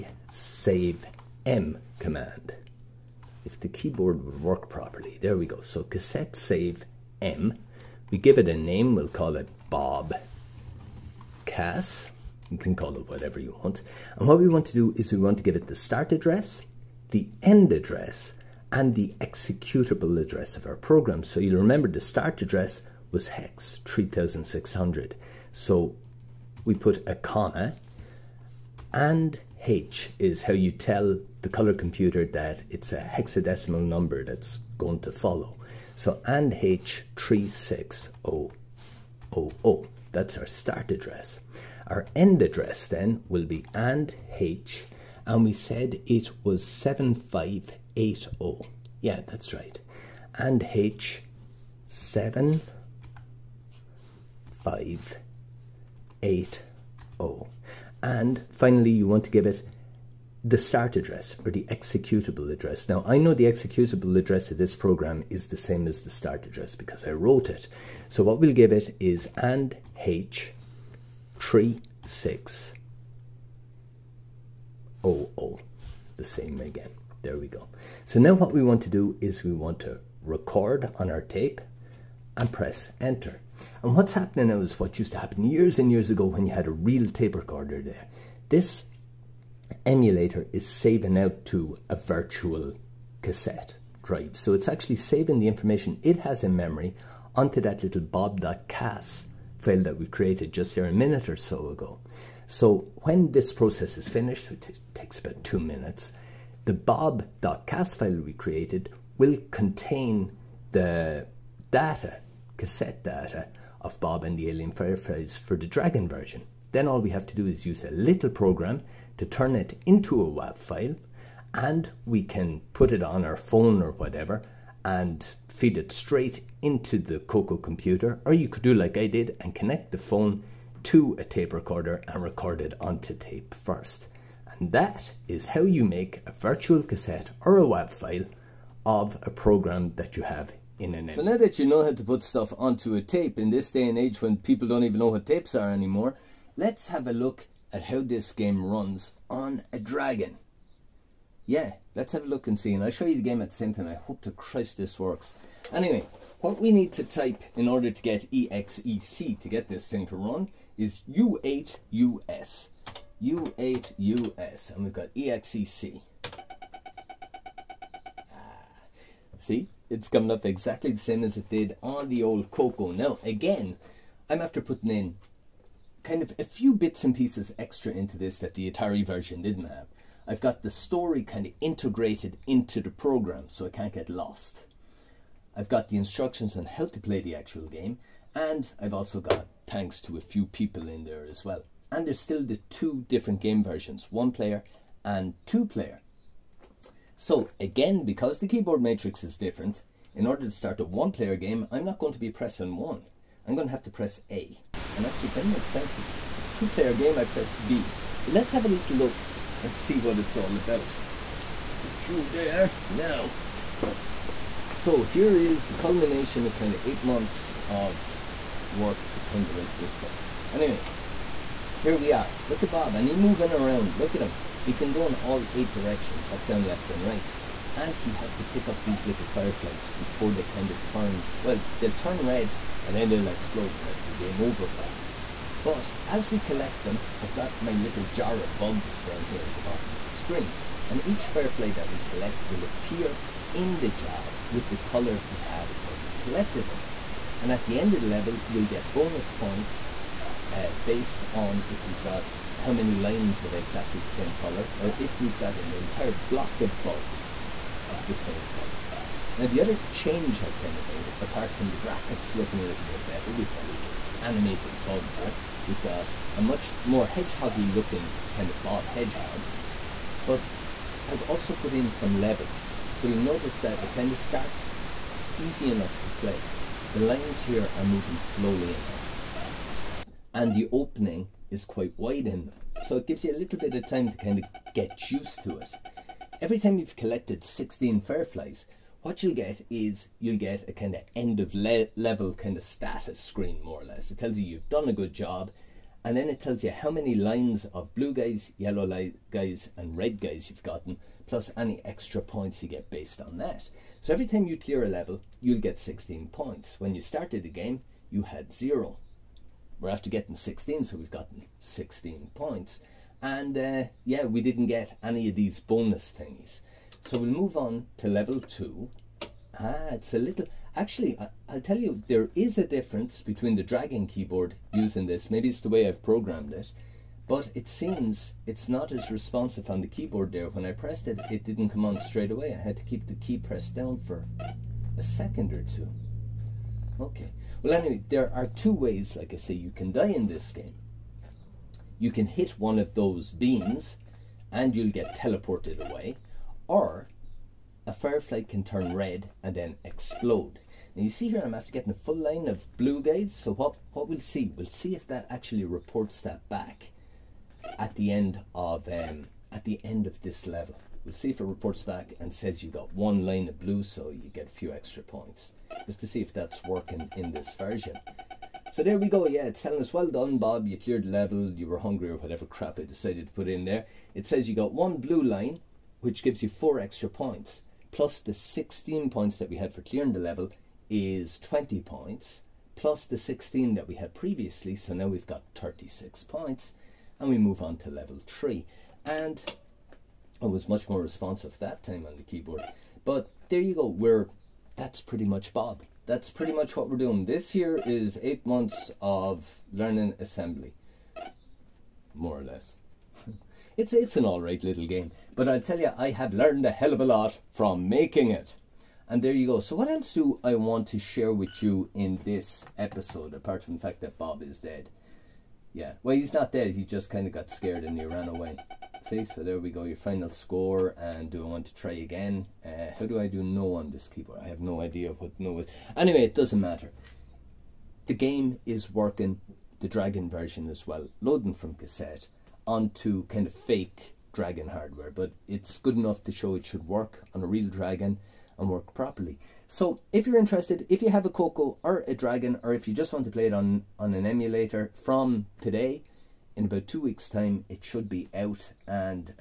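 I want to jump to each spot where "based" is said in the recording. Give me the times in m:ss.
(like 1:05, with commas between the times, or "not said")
4:10, 5:02.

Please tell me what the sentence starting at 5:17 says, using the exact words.
So we'll move on to level two.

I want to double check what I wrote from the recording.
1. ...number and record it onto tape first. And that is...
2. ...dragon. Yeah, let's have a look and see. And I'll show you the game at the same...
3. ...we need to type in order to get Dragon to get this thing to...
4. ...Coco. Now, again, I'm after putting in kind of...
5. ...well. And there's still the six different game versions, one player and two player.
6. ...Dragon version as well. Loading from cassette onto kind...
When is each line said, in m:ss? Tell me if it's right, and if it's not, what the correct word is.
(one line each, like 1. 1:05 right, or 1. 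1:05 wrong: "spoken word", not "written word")
1. 2:11 wrong: "recorder", not "number"
2. 2:29 right
3. 2:36 wrong: "EXEC", not "Dragon"
4. 2:52 right
5. 3:11 wrong: "two", not "six"
6. 7:09 right.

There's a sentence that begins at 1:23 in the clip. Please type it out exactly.
And what's happening now is what used to happen years and years ago when you had a real tape recorder there.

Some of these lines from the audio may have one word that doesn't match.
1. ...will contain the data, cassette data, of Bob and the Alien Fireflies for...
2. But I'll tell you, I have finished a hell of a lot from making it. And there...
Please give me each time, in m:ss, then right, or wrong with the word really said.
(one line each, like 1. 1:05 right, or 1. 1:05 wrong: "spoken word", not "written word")
1. 1:49 right
2. 6:45 wrong: "learned", not "finished".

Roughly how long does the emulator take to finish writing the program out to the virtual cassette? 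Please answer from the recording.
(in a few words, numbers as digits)
2 minutes.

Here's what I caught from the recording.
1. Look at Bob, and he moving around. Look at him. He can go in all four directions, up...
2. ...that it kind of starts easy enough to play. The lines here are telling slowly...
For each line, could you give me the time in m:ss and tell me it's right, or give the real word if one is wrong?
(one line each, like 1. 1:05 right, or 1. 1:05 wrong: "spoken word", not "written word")
1. 3:42 wrong: "eight", not "four"
2. 4:33 wrong: "moving", not "telling".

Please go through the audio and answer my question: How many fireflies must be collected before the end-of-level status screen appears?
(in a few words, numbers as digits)
16.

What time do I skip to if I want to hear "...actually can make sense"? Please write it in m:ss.
3:25.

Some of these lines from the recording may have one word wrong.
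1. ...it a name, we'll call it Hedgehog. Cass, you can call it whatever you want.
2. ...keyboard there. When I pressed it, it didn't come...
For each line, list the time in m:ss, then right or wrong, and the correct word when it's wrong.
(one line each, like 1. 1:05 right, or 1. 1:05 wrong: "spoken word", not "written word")
1. 0:08 wrong: "Bob", not "Hedgehog"
2. 5:29 right.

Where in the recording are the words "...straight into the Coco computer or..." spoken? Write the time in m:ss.
2:05.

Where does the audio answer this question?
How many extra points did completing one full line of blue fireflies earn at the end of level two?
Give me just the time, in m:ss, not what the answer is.
6:16.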